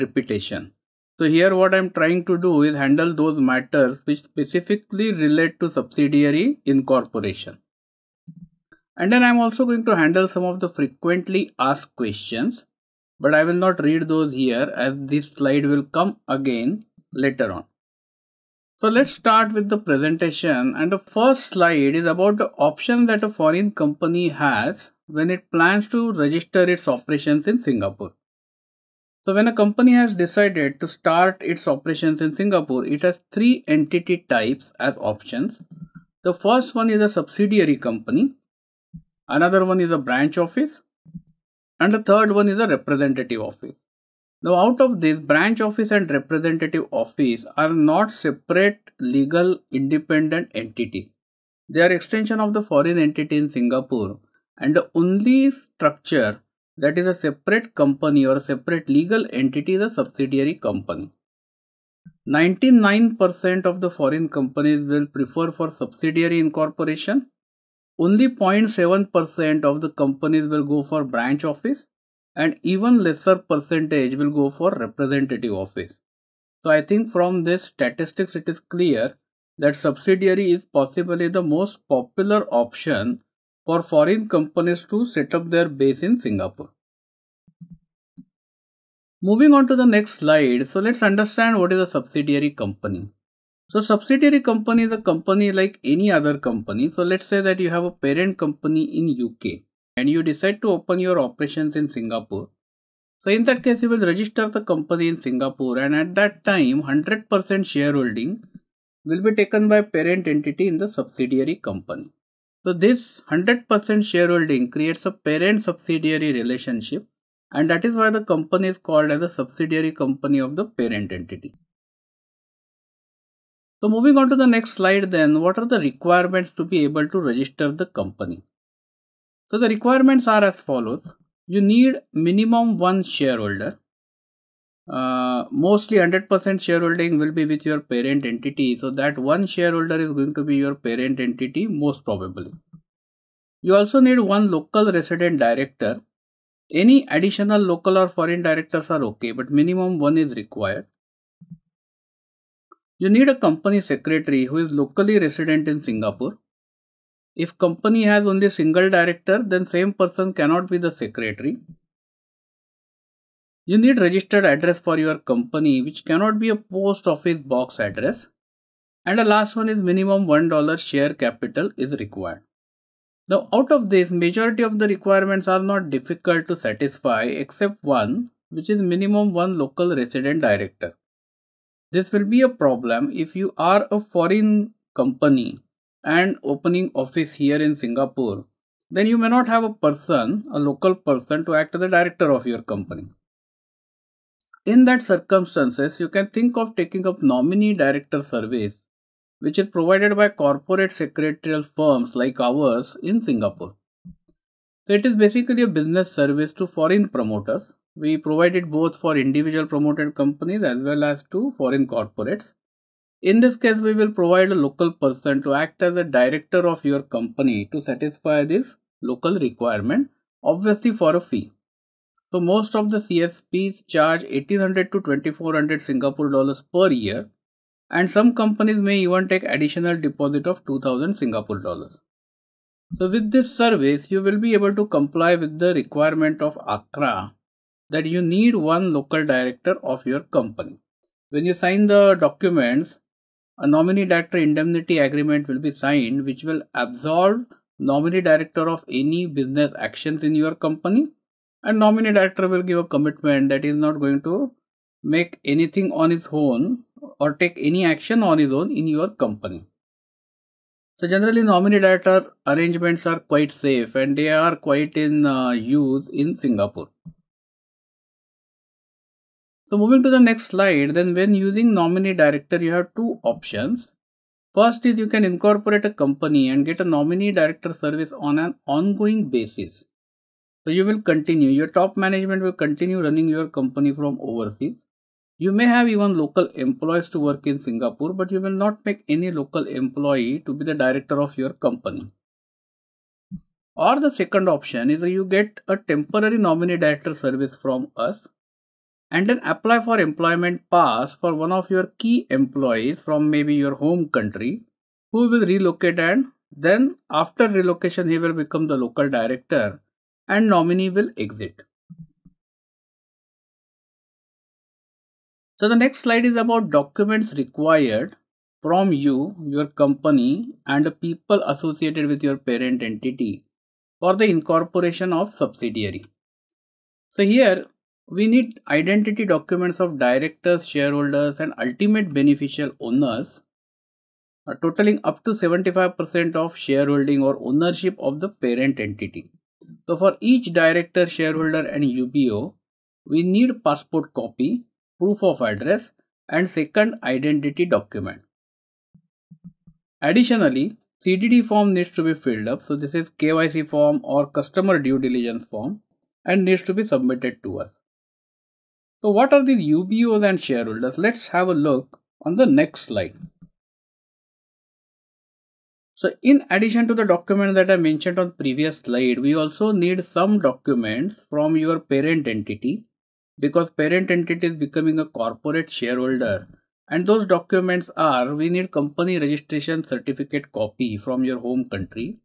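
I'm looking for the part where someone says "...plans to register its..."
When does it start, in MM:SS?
00:25.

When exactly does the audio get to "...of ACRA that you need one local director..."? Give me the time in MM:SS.
03:56.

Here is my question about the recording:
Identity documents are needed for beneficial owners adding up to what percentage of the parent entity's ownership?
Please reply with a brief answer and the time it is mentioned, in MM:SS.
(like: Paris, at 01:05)
75%, at 05:35.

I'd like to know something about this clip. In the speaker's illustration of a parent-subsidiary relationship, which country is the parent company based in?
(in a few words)
UK.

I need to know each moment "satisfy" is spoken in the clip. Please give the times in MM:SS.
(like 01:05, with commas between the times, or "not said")
02:56, 03:37.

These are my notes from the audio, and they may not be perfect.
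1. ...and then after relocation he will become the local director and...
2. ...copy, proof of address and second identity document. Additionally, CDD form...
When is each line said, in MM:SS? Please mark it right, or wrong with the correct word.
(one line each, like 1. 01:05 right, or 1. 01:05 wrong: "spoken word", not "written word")
1. 05:05 right
2. 05:44 right.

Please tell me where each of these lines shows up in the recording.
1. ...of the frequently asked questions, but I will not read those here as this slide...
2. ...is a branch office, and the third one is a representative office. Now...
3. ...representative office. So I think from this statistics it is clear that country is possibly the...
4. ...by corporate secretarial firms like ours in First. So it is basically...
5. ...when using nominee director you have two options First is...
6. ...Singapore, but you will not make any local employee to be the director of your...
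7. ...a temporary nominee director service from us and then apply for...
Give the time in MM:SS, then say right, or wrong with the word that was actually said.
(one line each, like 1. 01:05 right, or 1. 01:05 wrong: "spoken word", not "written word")
1. 00:10 right
2. 00:39 right
3. 01:14 wrong: "subsidiary", not "country"
4. 03:20 wrong: "Singapore", not "First"
5. 04:31 right
6. 04:47 right
7. 04:55 right.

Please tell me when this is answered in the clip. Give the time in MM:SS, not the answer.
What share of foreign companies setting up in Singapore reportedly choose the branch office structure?
01:08.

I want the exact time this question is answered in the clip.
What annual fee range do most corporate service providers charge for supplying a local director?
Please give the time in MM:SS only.
03:44.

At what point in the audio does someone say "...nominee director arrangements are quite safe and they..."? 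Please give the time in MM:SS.
04:21.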